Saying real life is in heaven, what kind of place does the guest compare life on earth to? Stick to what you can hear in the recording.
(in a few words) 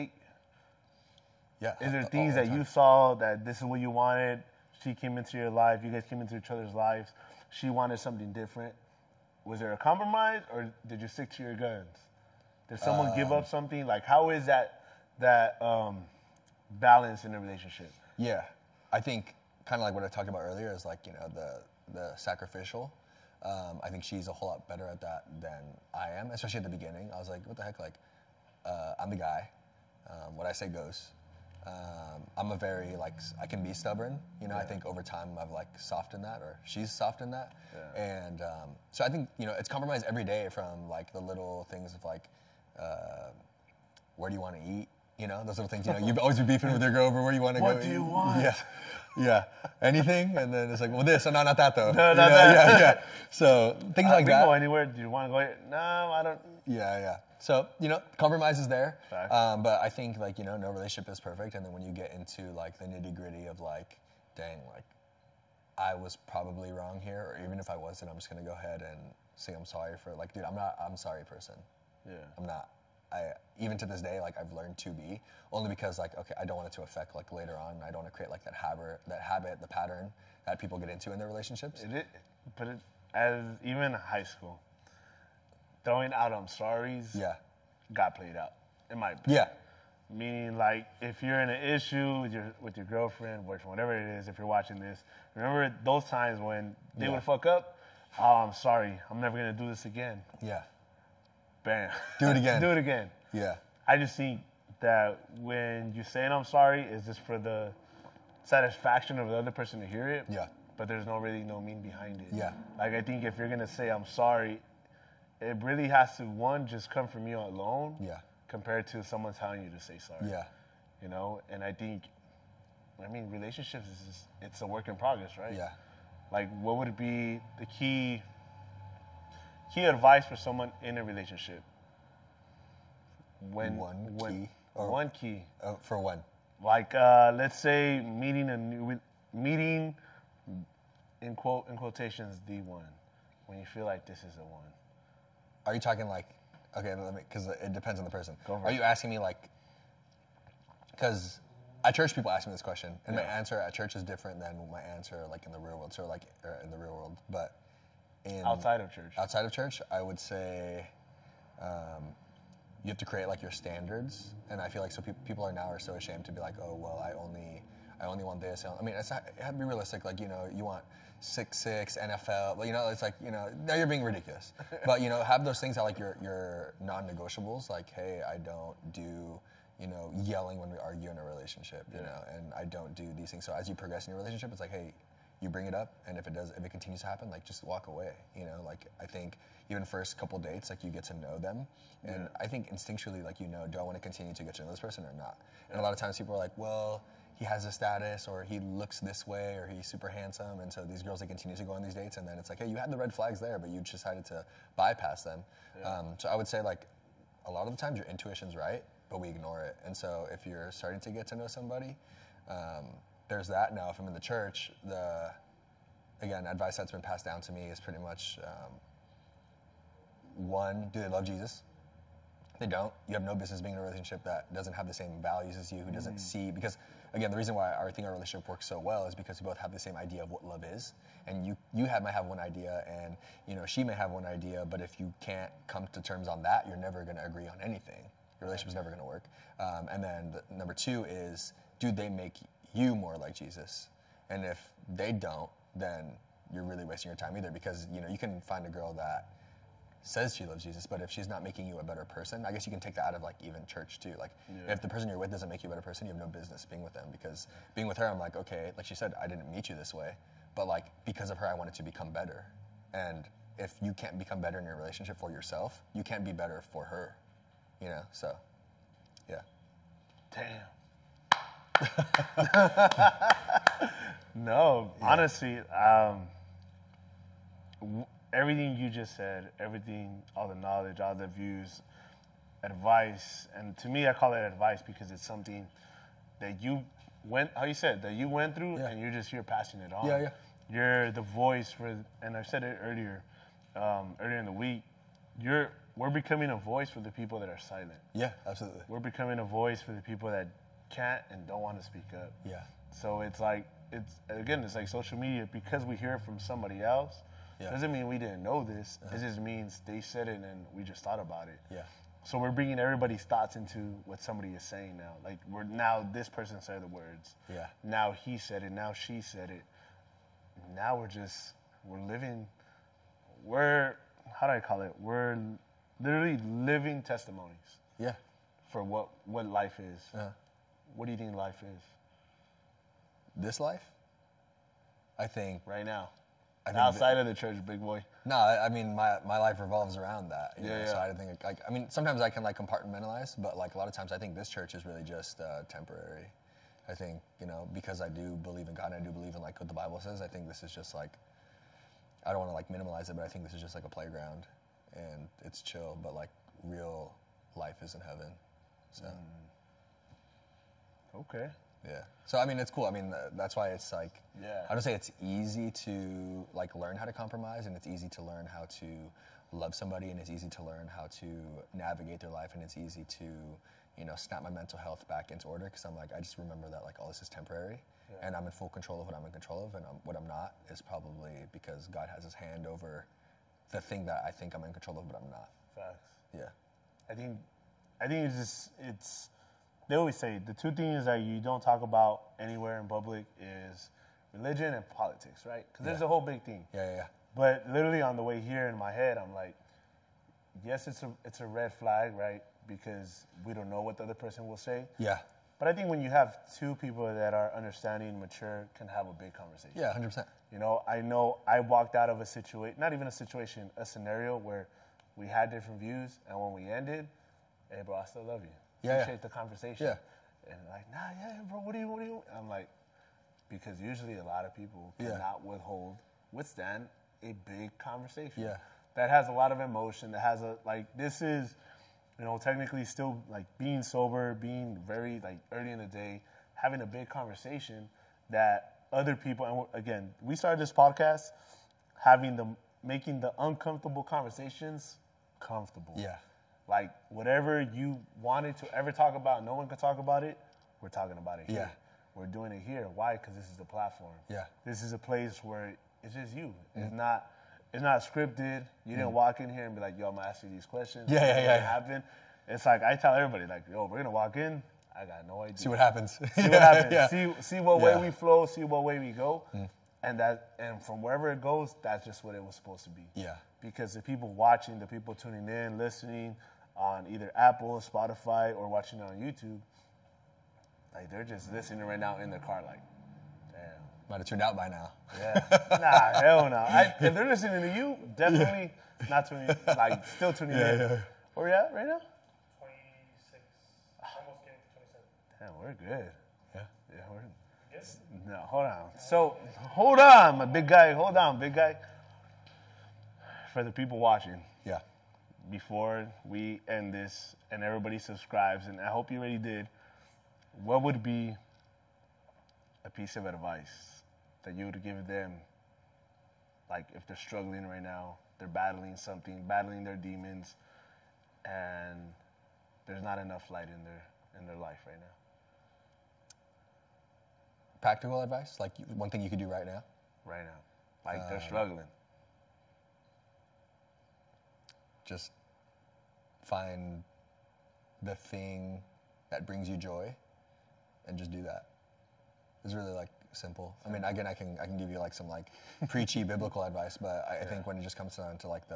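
a playground.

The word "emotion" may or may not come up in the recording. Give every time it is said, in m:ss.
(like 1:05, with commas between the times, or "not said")
7:09.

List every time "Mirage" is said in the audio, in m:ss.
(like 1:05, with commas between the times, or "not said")
not said.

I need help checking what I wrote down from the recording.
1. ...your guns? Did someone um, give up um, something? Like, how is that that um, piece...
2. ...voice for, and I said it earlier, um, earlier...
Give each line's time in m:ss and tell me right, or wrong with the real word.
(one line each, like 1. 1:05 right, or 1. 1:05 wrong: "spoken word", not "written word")
1. 0:11 wrong: "balance", not "piece"
2. 4:51 right.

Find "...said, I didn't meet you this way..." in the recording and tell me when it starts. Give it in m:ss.
4:18.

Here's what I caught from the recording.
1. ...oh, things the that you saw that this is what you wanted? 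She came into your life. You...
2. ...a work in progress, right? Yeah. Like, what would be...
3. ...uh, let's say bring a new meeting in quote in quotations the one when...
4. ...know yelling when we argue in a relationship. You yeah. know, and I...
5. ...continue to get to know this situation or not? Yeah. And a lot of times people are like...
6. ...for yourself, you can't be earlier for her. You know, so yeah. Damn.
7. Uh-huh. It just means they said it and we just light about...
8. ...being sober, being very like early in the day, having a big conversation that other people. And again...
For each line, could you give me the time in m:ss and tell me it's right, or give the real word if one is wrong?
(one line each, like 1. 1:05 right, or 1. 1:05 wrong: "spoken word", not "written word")
1. 0:02 right
2. 2:04 right
3. 2:16 wrong: "meeting", not "bring"
4. 2:59 right
5. 3:13 wrong: "person", not "situation"
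6. 4:25 wrong: "better", not "earlier"
7. 5:09 wrong: "thought", not "light"
8. 7:13 right.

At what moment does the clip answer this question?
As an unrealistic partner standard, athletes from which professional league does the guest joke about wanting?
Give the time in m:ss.
2:51.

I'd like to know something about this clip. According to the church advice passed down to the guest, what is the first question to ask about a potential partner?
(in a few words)
Do they love Jesus?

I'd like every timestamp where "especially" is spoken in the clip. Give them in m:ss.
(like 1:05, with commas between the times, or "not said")
0:26.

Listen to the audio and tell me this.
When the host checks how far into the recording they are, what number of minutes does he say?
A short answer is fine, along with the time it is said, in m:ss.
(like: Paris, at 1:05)
26, at 8:12.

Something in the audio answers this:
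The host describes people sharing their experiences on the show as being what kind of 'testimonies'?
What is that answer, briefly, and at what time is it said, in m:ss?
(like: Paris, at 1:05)
living testimonies, at 5:26.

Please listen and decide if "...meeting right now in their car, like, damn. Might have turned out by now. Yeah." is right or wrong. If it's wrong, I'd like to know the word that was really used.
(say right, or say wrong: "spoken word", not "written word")
wrong: "listening", not "meeting".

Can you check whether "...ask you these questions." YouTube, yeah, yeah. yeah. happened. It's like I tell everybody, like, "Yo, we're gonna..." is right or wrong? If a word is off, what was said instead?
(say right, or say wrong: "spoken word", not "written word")
wrong: "Yeah", not "YouTube".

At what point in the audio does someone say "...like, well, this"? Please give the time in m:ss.
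0:50.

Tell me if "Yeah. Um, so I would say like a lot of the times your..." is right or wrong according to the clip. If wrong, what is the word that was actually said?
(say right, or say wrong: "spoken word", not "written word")
right.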